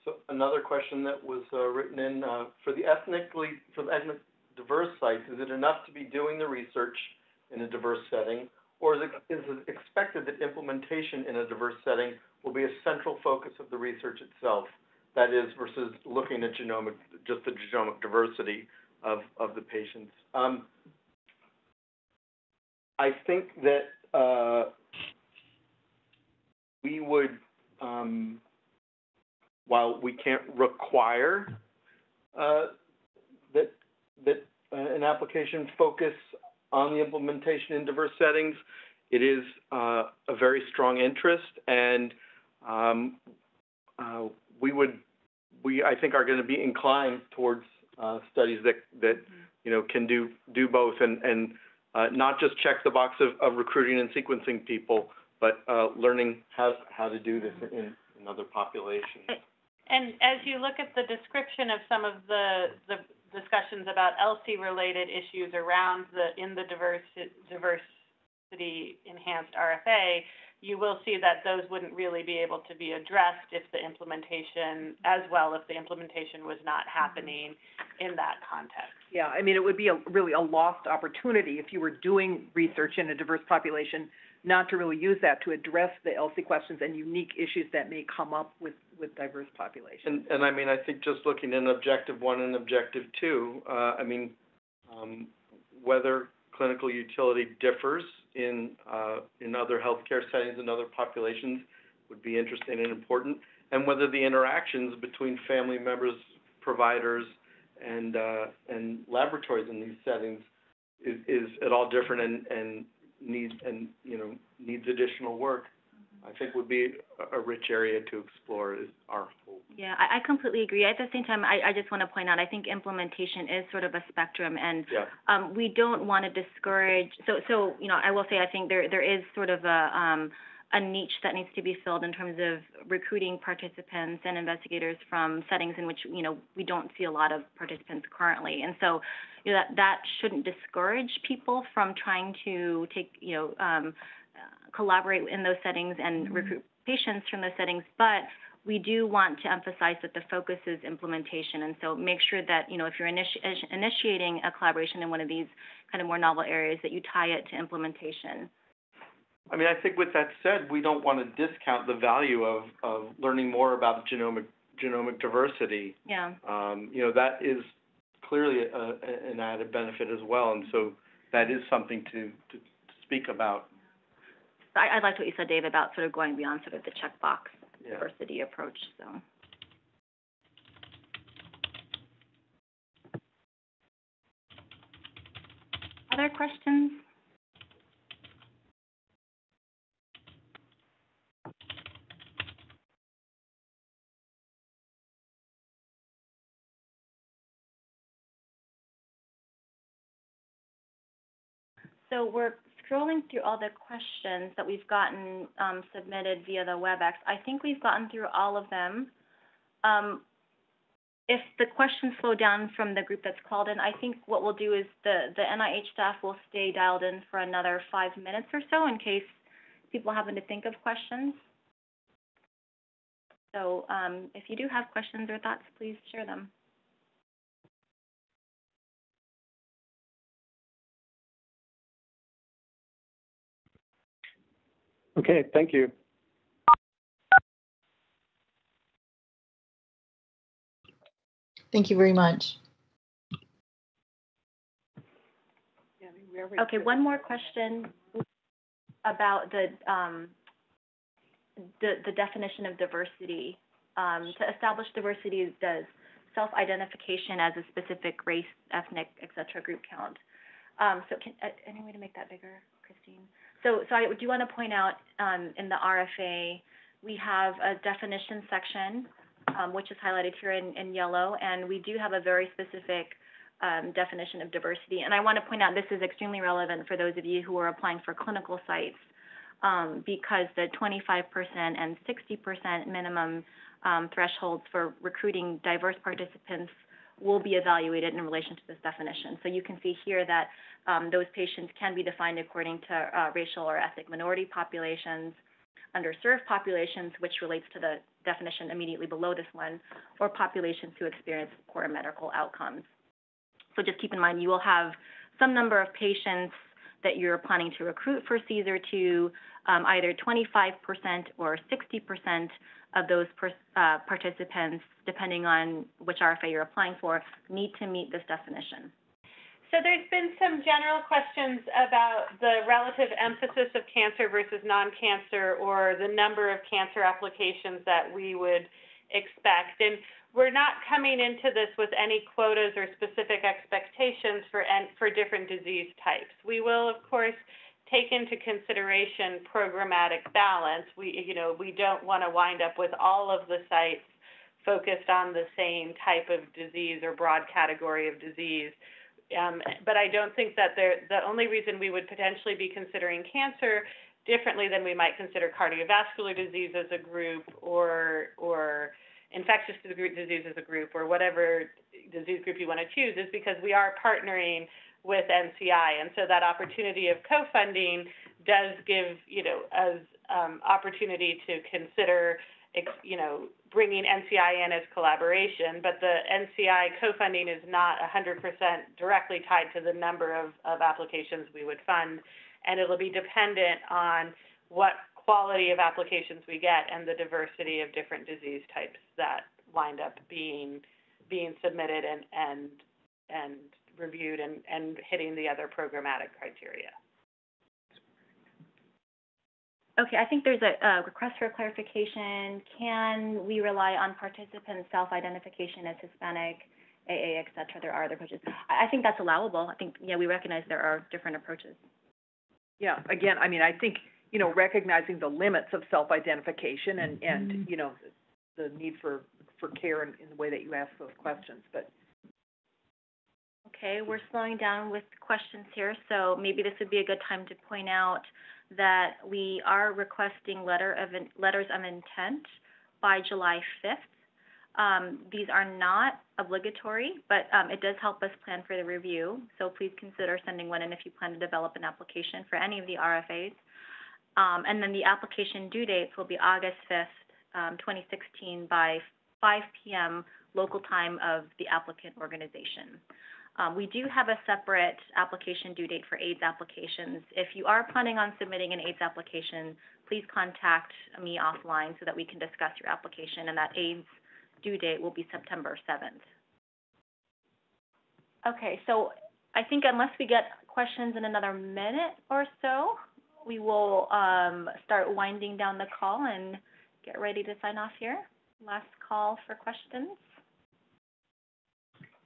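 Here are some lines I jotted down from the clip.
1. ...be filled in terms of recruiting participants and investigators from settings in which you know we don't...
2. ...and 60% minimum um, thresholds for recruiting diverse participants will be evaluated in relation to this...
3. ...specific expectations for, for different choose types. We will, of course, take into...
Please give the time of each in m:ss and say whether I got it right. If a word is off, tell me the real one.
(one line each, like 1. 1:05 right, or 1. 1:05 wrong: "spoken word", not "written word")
1. 2:11 right
2. 4:41 right
3. 5:32 wrong: "disease", not "choose".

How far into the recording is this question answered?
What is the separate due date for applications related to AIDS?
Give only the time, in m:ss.
7:45.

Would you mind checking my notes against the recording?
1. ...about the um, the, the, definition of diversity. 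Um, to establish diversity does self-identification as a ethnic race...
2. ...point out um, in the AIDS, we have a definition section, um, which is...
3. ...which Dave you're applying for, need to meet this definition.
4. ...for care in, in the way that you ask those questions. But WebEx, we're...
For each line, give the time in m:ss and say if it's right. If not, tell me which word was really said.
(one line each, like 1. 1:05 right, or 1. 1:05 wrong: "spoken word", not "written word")
1. 4:09 wrong: "specific", not "ethnic"
2. 4:24 wrong: "RFA", not "AIDS"
3. 5:15 wrong: "RFA", not "Dave"
4. 6:59 wrong: "Okay", not "WebEx".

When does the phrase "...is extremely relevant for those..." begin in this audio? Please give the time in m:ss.
4:35.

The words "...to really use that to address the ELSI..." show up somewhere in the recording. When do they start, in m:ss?
1:24.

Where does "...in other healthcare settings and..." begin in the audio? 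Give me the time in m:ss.
1:39.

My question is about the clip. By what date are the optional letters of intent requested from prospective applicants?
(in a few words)
July 5th.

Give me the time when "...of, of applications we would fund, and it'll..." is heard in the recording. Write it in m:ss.
6:20.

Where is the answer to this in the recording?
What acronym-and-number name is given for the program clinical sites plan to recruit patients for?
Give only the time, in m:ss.
5:08.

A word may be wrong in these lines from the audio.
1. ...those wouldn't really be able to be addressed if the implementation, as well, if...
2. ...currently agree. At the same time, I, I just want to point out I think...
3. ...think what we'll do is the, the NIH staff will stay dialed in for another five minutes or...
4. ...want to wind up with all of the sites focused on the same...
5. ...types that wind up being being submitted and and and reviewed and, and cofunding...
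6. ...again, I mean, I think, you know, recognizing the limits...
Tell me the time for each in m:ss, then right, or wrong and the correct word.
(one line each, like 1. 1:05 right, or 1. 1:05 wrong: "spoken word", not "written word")
1. 1:11 right
2. 2:00 wrong: "completely", not "currently"
3. 3:34 right
4. 5:42 right
5. 6:28 wrong: "hitting", not "cofunding"
6. 6:53 right.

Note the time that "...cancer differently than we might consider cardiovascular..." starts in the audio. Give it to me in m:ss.
5:53.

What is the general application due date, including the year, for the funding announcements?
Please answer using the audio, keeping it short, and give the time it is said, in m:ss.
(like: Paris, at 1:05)
August 5th, 2016, at 7:26.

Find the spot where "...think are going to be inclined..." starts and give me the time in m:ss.
0:45.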